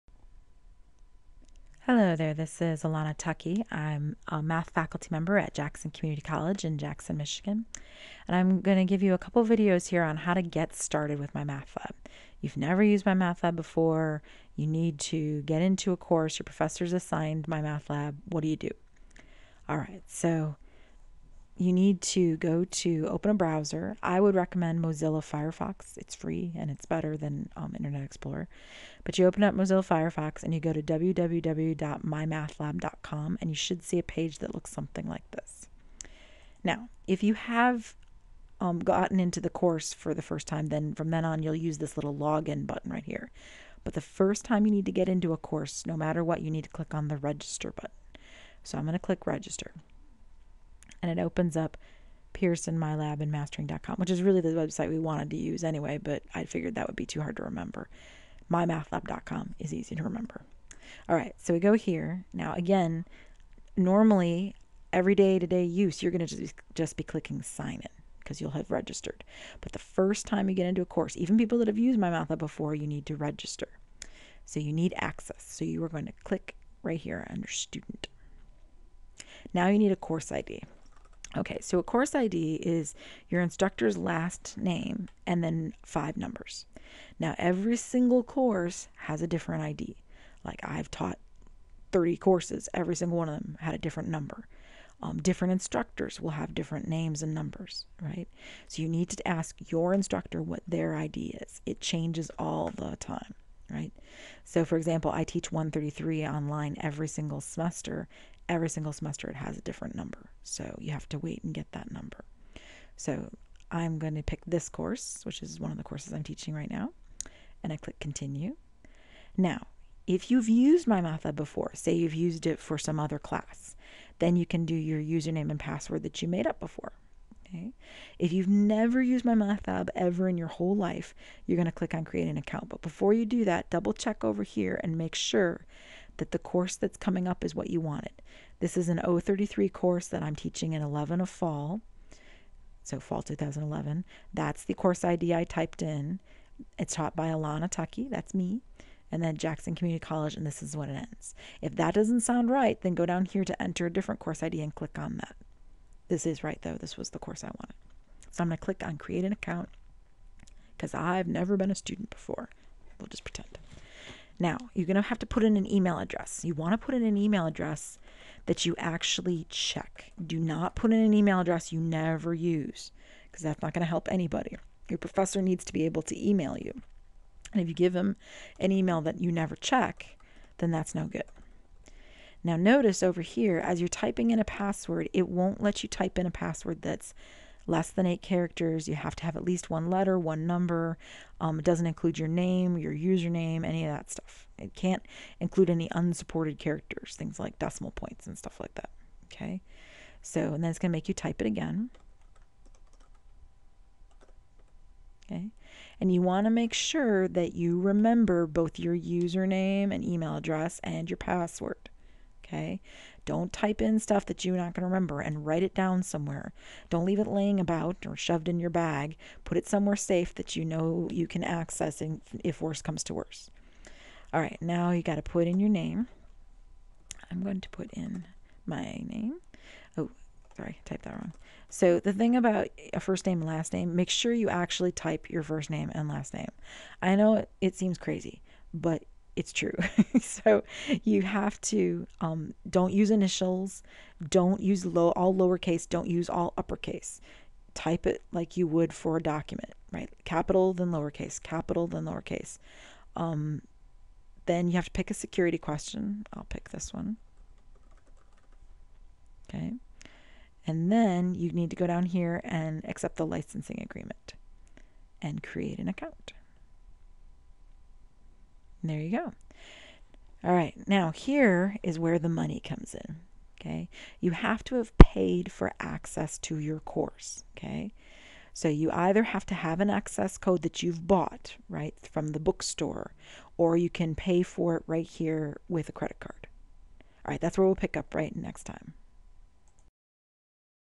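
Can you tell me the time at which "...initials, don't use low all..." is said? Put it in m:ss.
4:03.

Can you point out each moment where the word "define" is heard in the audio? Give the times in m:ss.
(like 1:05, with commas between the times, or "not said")
not said.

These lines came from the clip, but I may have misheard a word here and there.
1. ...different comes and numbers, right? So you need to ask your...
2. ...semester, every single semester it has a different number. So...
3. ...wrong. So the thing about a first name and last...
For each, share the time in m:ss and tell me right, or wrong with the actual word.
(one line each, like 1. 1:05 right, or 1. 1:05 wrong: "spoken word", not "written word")
1. 1:36 wrong: "names", not "comes"
2. 1:47 right
3. 3:51 right.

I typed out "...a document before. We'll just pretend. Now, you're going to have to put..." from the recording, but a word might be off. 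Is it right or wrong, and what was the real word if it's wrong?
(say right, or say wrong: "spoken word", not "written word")
wrong: "student", not "document".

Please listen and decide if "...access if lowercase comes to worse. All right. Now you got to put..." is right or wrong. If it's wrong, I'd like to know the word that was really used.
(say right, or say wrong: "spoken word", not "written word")
wrong: "worse", not "lowercase".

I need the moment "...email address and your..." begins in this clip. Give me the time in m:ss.
3:30.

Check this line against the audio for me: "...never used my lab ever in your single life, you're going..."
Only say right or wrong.
wrong.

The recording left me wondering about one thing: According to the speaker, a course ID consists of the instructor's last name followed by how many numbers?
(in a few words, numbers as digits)
5.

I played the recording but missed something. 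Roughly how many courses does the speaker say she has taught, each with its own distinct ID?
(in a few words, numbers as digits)
30.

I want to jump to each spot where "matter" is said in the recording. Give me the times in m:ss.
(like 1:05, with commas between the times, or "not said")
0:45.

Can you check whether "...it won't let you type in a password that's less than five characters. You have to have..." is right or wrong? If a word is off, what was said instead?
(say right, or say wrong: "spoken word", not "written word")
wrong: "eight", not "five".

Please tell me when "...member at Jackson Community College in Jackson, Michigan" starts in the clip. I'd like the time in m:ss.
0:05.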